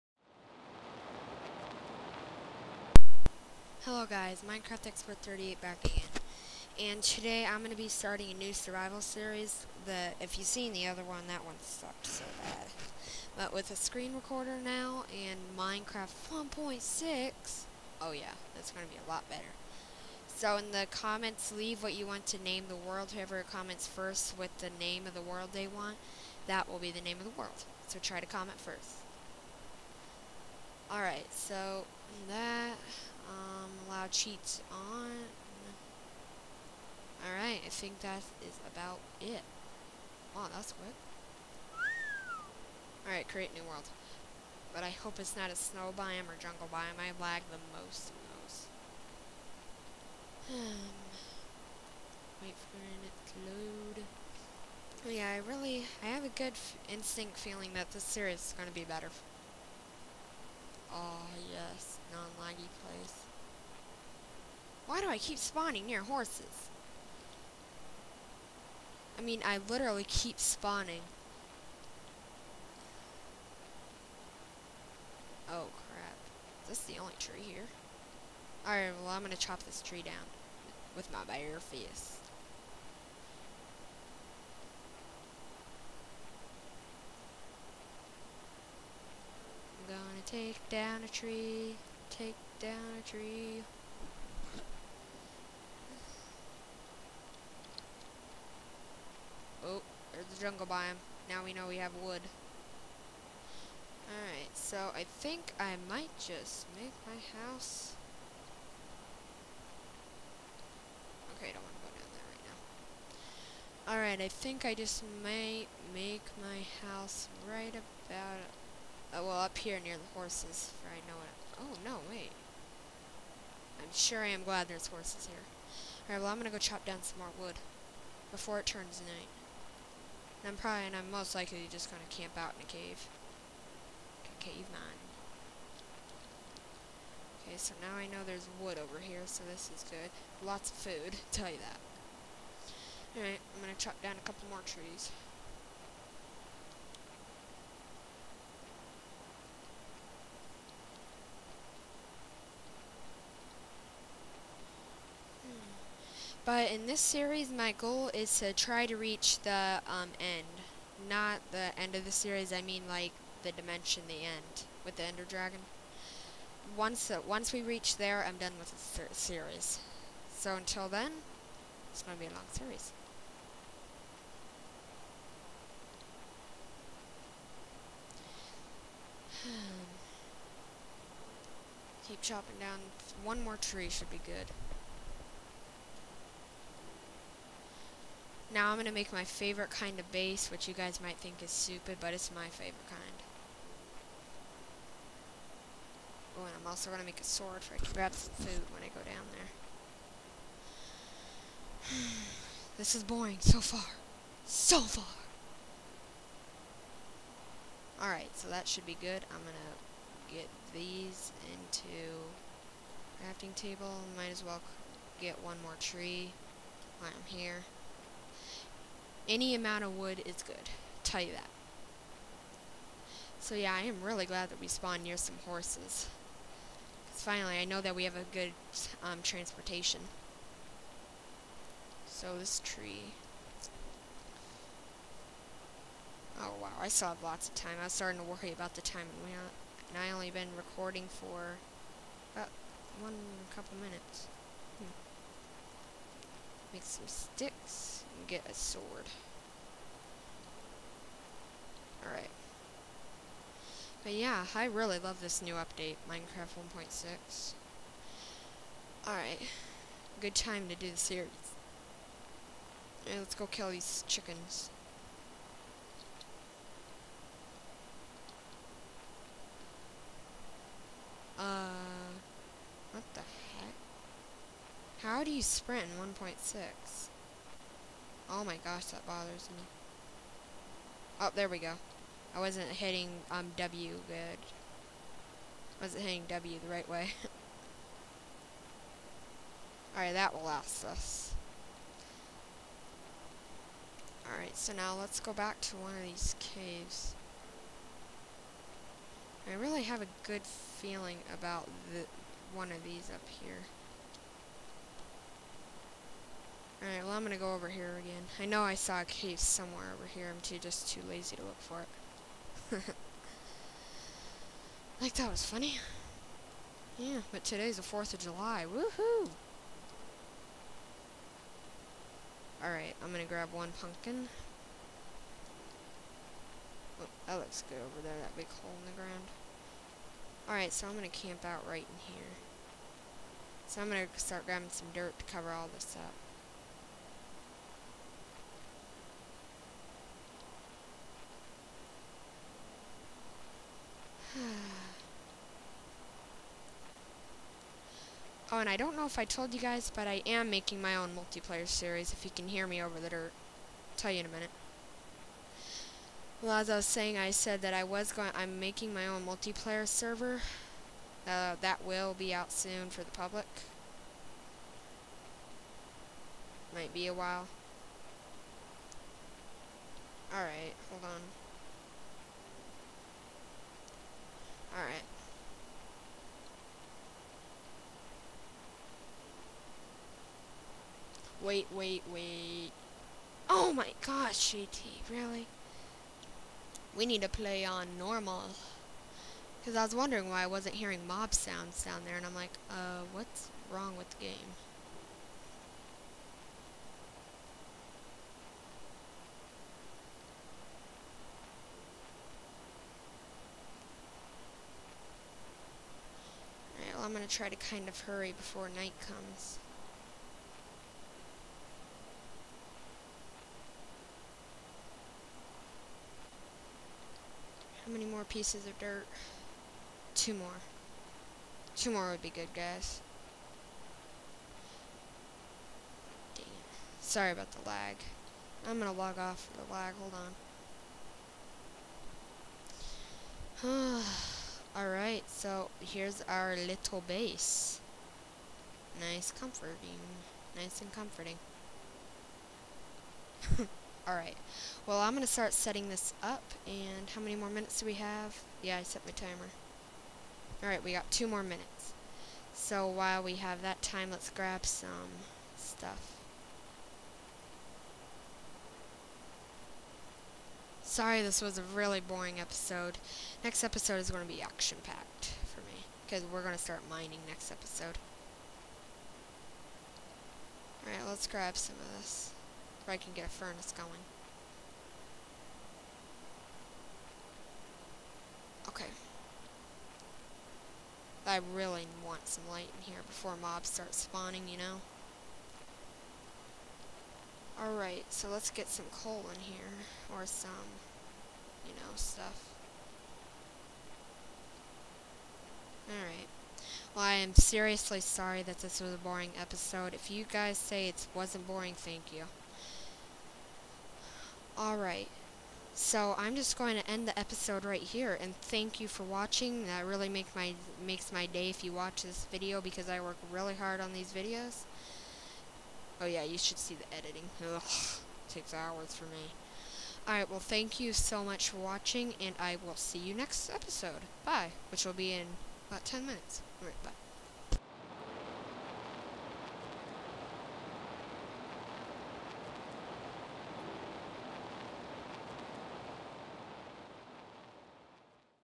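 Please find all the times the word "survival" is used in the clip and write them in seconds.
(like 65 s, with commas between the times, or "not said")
8 s.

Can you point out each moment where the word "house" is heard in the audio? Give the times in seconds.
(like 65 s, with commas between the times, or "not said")
107 s, 116 s.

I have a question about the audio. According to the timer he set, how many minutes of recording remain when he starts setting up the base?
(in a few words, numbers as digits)
2.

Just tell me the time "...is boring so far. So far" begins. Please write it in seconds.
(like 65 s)
202 s.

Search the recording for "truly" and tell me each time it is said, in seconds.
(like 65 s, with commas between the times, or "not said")
not said.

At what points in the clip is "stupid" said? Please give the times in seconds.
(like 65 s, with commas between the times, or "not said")
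191 s.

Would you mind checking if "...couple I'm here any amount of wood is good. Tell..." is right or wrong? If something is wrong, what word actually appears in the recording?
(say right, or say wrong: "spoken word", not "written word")
wrong: "while", not "couple".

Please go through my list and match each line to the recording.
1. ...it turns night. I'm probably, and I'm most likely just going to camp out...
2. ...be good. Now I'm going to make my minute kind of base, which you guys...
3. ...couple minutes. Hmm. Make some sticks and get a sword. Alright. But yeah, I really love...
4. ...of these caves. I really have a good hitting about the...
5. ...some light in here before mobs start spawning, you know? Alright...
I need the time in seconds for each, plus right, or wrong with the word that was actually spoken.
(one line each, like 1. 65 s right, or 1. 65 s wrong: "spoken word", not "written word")
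1. 128 s right
2. 184 s wrong: "favorite", not "minute"
3. 243 s right
4. 295 s wrong: "feeling", not "hitting"
5. 482 s right.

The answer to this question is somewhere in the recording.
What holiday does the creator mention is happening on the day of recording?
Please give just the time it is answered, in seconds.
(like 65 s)
317 s.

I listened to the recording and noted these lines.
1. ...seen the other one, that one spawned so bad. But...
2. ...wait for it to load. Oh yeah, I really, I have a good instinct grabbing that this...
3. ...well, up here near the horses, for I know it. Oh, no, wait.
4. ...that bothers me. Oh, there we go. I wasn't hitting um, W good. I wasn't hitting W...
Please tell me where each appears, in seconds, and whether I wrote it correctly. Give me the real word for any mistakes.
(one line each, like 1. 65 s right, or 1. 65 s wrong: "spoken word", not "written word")
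1. 10 s wrong: "sucked", not "spawned"
2. 52 s wrong: "feeling", not "grabbing"
3. 119 s right
4. 278 s right.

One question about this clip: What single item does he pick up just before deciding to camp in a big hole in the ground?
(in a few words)
pumpkin.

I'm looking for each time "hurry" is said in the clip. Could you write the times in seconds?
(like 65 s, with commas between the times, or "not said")
408 s.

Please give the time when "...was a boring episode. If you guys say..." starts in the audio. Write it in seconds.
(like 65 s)
498 s.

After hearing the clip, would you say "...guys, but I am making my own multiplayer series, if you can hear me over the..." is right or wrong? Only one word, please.
right.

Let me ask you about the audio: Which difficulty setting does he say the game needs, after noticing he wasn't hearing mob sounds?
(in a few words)
normal.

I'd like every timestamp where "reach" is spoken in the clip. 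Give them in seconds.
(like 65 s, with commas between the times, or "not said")
158 s, 167 s.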